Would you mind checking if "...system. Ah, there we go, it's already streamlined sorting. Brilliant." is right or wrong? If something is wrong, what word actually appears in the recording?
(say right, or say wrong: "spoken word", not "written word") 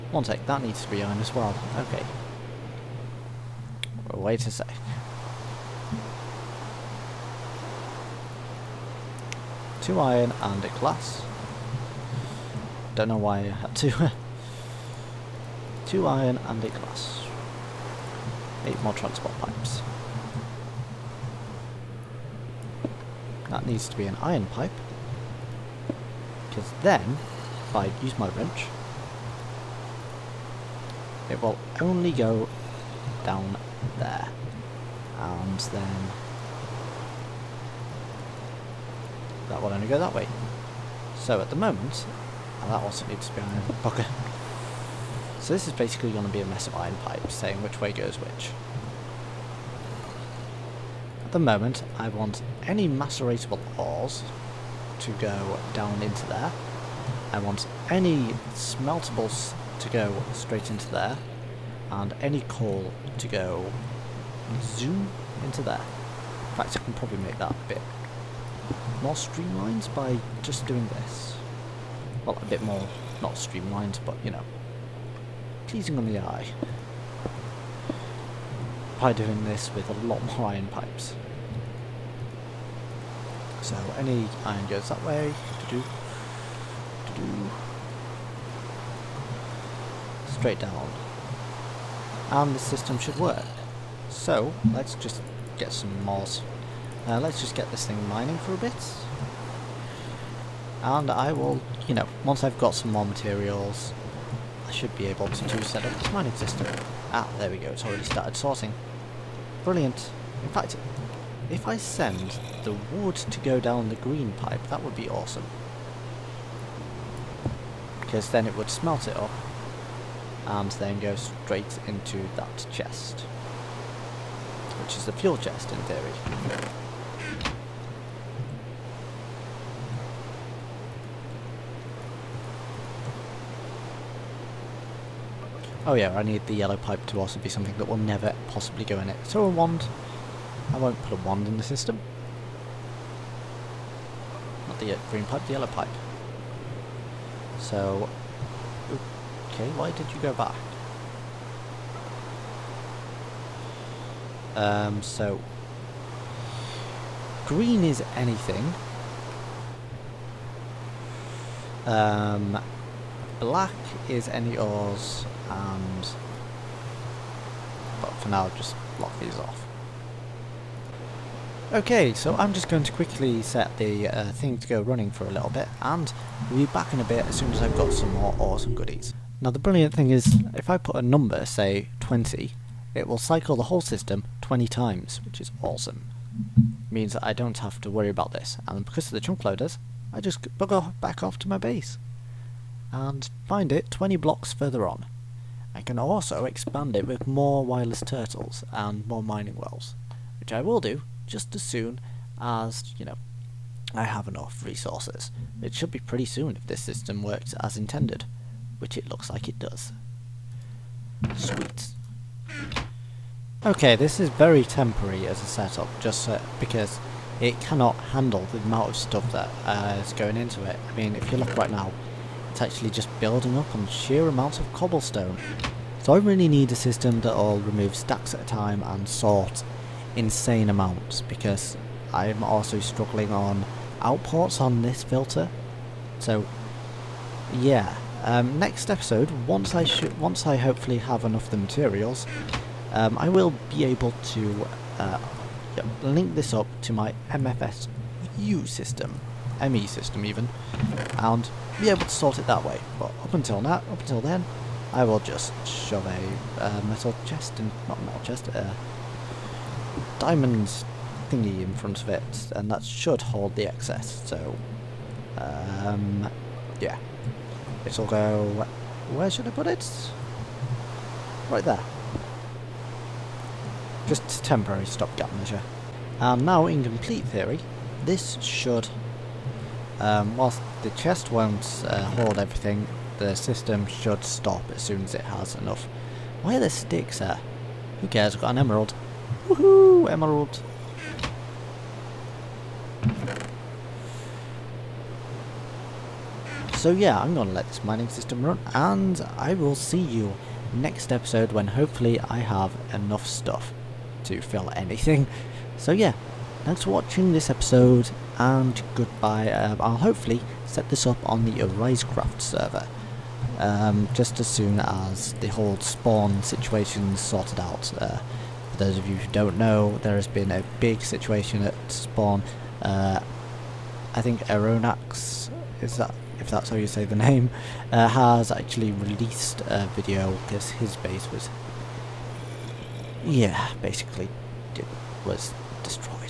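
wrong: "started", not "streamlined".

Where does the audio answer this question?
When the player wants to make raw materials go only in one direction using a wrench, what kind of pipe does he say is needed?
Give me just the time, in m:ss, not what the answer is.
0:24.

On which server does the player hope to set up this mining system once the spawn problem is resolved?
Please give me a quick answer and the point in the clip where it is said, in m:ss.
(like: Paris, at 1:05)
Arisecraft, at 5:11.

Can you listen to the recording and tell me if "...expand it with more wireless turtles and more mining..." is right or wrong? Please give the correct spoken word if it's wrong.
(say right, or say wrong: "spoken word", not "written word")
right.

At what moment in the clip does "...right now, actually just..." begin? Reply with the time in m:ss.
3:41.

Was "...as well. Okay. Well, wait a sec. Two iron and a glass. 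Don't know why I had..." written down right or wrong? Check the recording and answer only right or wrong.
right.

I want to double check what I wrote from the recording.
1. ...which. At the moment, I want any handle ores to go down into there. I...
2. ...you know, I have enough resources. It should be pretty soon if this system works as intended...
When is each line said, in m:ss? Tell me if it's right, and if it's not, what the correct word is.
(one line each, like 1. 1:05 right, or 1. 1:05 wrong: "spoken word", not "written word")
1. 0:48 wrong: "maceratable", not "handle"
2. 3:22 right.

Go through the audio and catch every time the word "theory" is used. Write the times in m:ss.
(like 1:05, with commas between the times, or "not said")
2:05, 4:37.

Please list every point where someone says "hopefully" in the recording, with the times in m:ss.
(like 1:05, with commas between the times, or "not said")
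4:00, 5:01, 5:09.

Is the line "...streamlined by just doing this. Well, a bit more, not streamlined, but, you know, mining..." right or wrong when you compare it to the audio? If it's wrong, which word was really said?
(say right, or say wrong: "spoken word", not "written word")
wrong: "pleasing", not "mining".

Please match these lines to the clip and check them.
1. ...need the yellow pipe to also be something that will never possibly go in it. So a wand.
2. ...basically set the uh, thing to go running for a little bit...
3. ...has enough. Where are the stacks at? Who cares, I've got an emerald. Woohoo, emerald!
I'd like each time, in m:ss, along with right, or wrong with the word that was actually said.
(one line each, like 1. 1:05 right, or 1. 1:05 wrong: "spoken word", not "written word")
1. 2:16 right
2. 2:52 wrong: "quickly", not "basically"
3. 4:45 wrong: "sticks", not "stacks".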